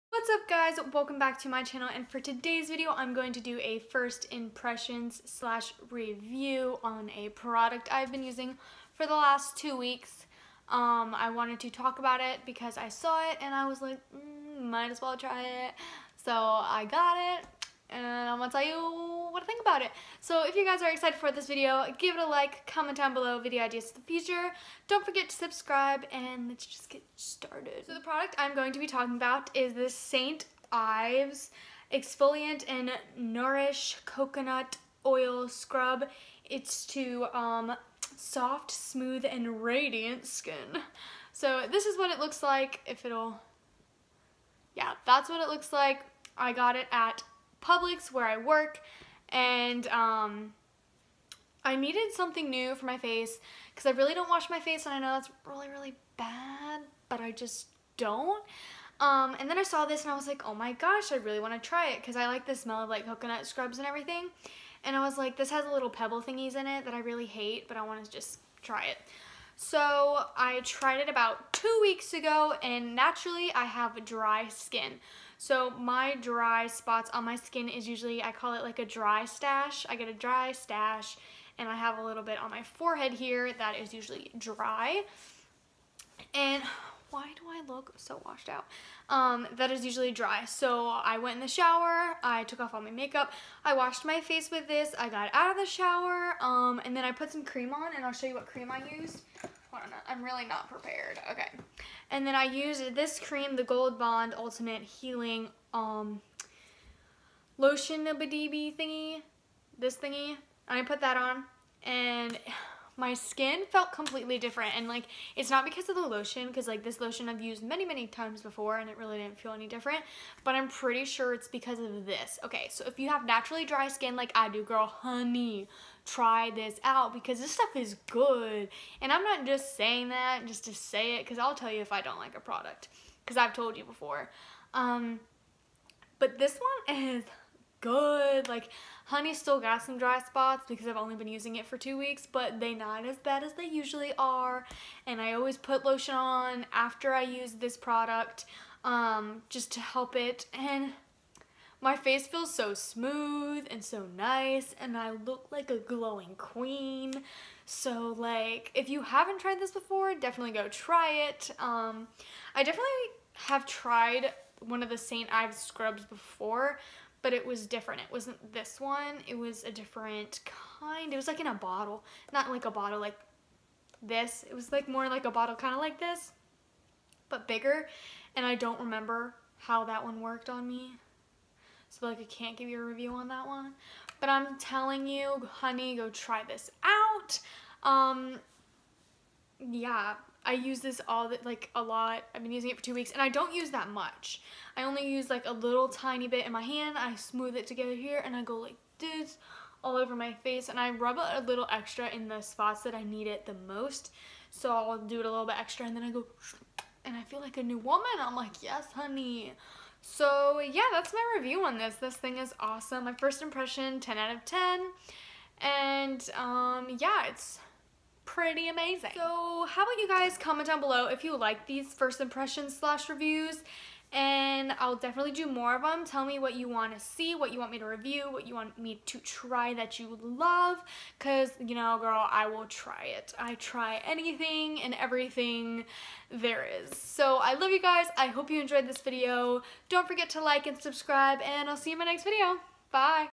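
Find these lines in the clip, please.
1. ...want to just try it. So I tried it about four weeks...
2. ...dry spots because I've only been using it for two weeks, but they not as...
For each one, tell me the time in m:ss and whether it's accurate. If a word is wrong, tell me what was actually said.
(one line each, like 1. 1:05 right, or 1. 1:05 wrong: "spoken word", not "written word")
1. 1:07 wrong: "two", not "four"
2. 2:19 right.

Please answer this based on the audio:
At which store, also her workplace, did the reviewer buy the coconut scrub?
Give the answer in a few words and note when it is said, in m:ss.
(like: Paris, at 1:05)
Publix, at 0:47.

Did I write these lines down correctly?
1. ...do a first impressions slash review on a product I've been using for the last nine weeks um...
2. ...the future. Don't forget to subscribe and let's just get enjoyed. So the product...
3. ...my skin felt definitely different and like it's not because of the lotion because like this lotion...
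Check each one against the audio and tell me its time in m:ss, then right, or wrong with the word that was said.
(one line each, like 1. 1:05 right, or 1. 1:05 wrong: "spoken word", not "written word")
1. 0:03 wrong: "two", not "nine"
2. 0:23 wrong: "started", not "enjoyed"
3. 1:53 wrong: "completely", not "definitely".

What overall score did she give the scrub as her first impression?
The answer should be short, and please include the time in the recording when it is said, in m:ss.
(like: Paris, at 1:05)
10 out of 10, at 3:33.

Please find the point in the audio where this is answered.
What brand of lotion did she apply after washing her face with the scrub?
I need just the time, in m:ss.
1:43.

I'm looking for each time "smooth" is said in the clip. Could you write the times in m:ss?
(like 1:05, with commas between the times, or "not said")
0:38, 2:32, 3:17.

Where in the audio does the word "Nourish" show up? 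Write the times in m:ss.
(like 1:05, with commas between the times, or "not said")
0:33.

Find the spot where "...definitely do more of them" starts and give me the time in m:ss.
3:44.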